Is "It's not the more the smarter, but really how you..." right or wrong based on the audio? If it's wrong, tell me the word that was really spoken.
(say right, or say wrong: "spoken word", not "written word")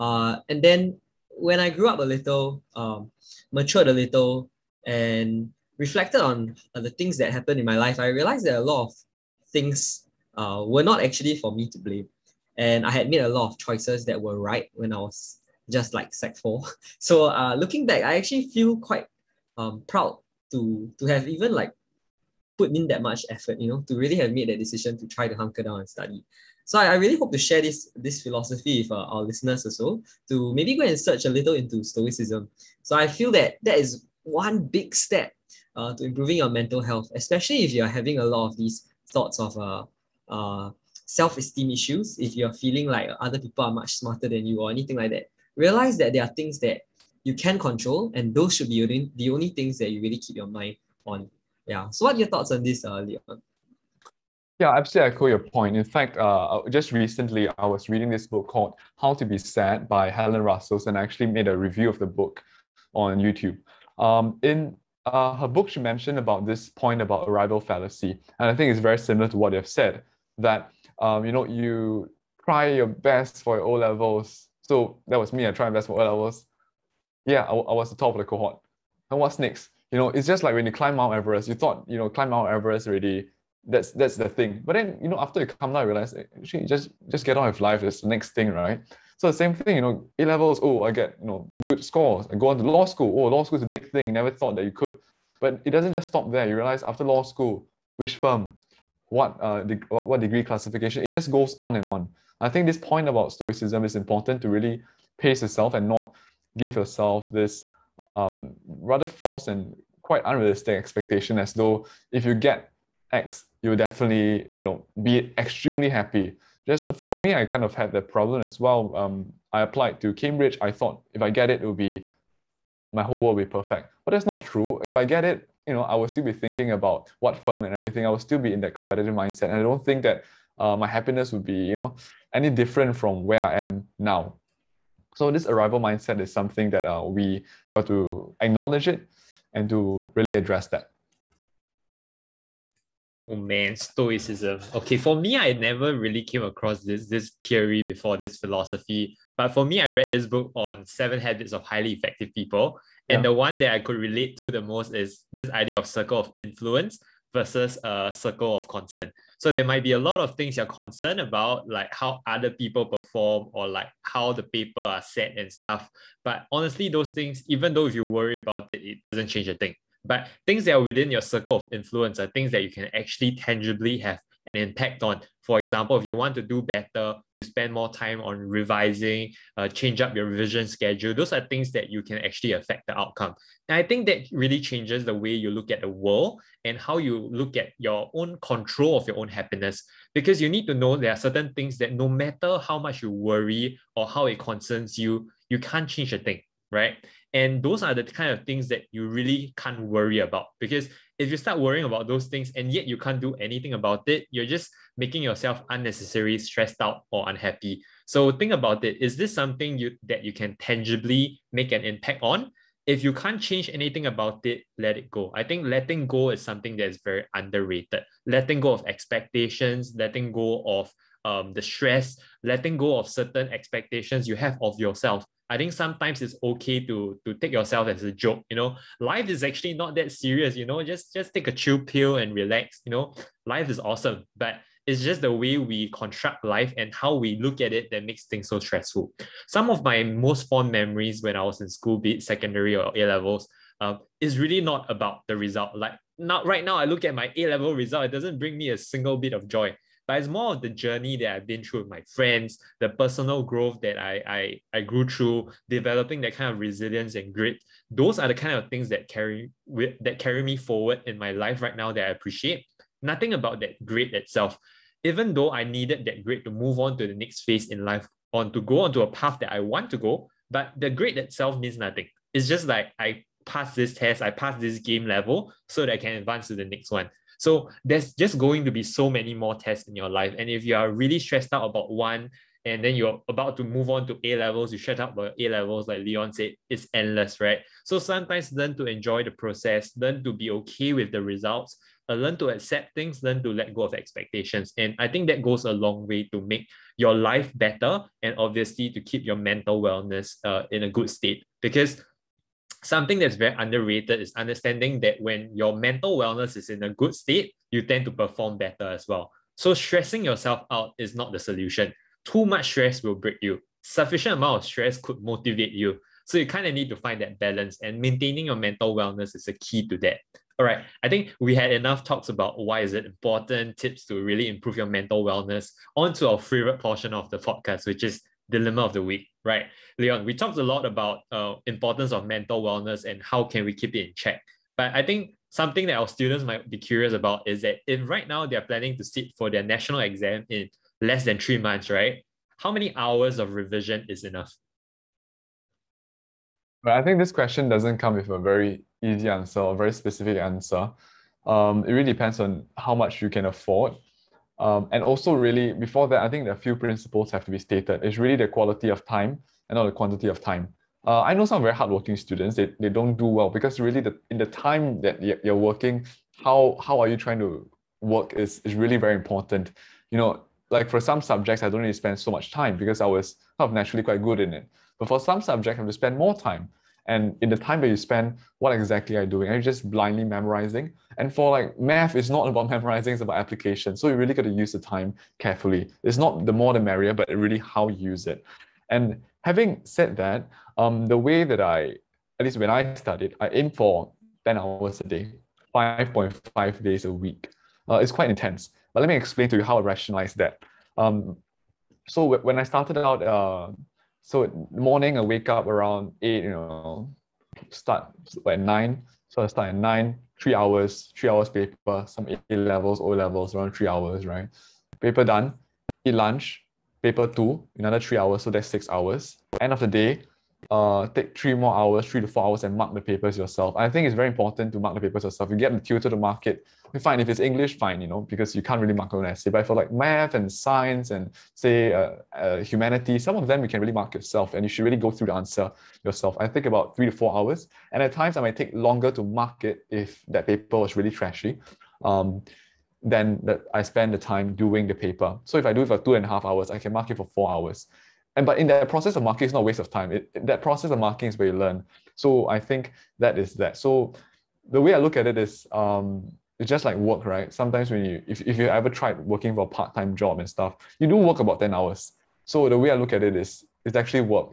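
wrong: "merrier", not "smarter".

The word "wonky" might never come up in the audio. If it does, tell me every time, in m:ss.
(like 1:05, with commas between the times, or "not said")
not said.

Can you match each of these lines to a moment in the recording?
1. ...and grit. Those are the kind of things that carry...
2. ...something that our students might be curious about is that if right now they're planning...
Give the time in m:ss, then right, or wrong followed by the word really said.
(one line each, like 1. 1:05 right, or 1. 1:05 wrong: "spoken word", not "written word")
1. 4:17 right
2. 5:35 right.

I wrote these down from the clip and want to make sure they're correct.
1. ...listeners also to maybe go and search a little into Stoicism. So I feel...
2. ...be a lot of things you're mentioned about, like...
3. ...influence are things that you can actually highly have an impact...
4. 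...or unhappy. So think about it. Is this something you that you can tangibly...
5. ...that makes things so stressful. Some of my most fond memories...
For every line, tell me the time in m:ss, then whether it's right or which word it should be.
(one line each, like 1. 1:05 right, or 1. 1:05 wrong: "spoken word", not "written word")
1. 0:29 right
2. 2:39 wrong: "concerned", not "mentioned"
3. 2:51 wrong: "tangibly", not "highly"
4. 3:27 right
5. 3:57 right.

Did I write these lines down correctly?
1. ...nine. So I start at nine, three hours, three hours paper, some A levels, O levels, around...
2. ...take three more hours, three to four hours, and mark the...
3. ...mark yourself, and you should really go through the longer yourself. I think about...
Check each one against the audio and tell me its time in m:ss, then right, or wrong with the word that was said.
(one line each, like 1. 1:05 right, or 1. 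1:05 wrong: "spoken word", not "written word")
1. 6:48 right
2. 7:01 right
3. 7:13 wrong: "answer", not "longer".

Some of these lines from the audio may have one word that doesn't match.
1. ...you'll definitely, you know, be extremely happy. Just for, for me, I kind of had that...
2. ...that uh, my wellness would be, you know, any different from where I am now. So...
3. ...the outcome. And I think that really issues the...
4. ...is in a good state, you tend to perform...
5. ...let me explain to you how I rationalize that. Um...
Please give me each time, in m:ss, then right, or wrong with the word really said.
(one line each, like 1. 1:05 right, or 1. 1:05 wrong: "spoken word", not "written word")
1. 1:53 right
2. 2:10 wrong: "happiness", not "wellness"
3. 3:02 wrong: "changes", not "issues"
4. 5:06 right
5. 6:39 right.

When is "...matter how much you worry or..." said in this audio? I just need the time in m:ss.
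3:12.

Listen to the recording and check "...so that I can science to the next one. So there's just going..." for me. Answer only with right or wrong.
wrong.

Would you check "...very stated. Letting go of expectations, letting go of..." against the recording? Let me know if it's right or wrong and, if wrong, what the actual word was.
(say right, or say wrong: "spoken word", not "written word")
wrong: "underrated", not "stated".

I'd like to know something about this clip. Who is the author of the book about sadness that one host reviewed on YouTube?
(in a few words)
Helen Russell.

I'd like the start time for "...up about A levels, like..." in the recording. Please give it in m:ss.
4:44.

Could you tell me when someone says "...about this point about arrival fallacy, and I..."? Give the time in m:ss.
1:06.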